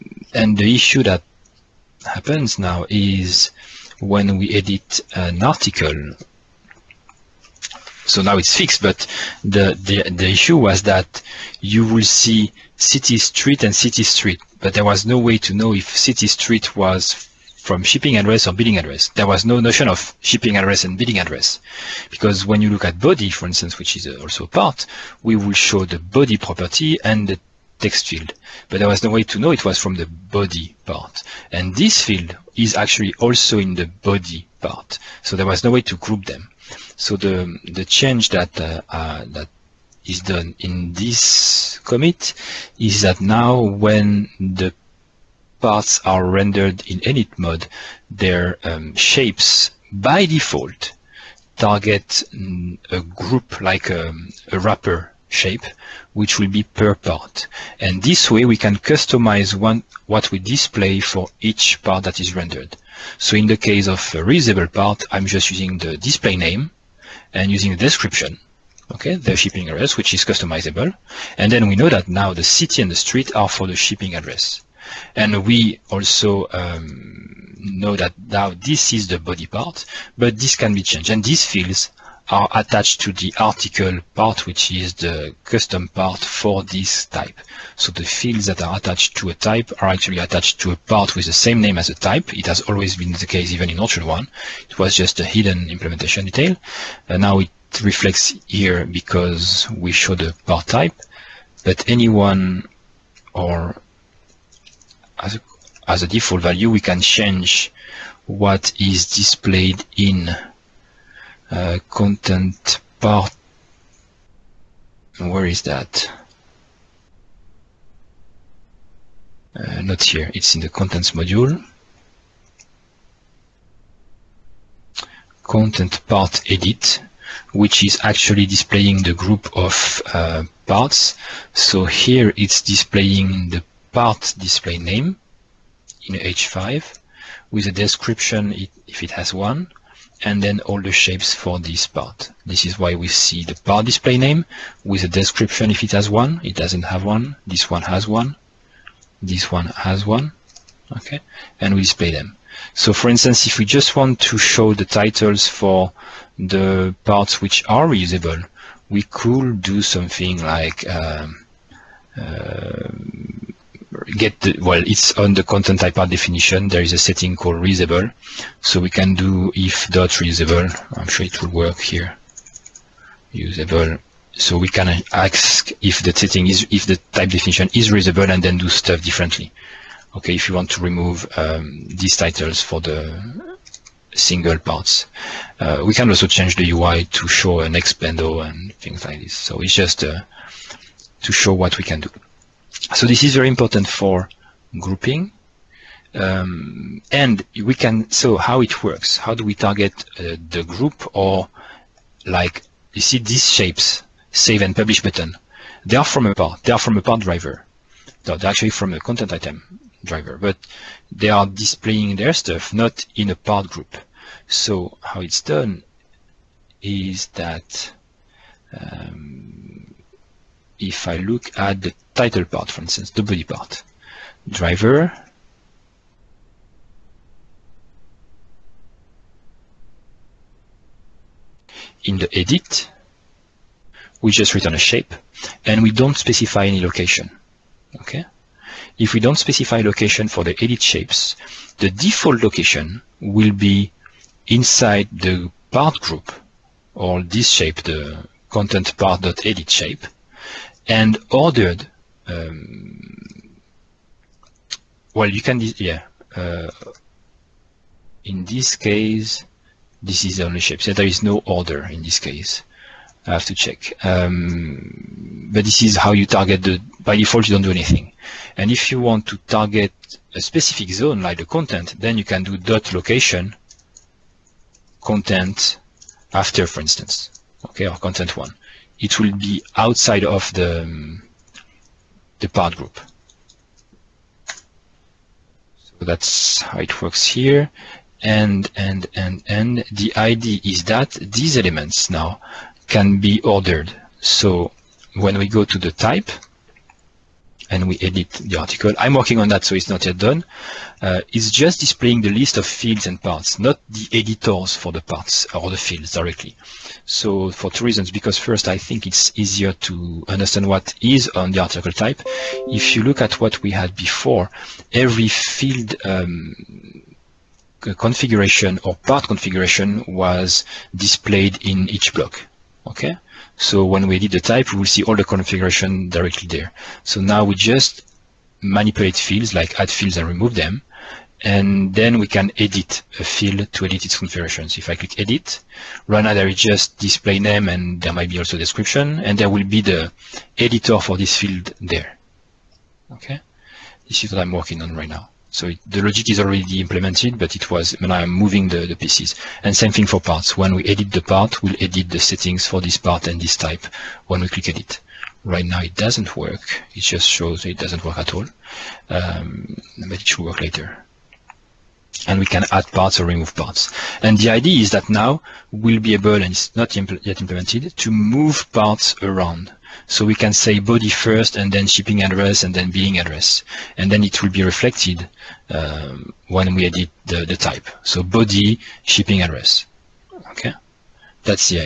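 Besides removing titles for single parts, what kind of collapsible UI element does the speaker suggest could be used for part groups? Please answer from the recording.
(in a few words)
an expando.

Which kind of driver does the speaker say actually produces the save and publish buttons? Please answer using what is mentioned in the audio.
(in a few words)
content item driver.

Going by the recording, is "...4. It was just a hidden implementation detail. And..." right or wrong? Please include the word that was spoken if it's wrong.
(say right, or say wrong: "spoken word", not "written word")
wrong: "1", not "4".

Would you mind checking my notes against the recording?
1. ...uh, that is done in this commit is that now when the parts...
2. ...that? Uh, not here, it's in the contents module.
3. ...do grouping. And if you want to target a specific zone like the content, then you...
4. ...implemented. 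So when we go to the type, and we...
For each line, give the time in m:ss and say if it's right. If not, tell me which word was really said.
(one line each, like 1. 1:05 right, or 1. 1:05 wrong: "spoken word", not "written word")
1. 0:38 right
2. 1:55 right
3. 4:27 wrong: "anything", not "grouping"
4. 4:53 wrong: "ordered", not "implemented".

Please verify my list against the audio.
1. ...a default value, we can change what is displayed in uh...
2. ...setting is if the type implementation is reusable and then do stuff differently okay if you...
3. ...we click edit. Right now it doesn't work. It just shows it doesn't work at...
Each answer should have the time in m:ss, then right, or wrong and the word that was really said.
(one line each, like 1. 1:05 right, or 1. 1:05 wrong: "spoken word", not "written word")
1. 1:46 right
2. 2:56 wrong: "definition", not "implementation"
3. 5:54 right.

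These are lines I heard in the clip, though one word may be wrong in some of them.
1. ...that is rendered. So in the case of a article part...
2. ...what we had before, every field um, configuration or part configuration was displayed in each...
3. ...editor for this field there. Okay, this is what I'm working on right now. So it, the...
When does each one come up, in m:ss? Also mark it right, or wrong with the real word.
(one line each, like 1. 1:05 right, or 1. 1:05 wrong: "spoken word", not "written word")
1. 1:02 wrong: "reusable", not "article"
2. 5:13 right
3. 5:40 right.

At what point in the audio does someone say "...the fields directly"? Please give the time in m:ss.
5:05.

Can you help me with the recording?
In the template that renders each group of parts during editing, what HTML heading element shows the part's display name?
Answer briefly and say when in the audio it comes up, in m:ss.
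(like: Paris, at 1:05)
H5, at 2:16.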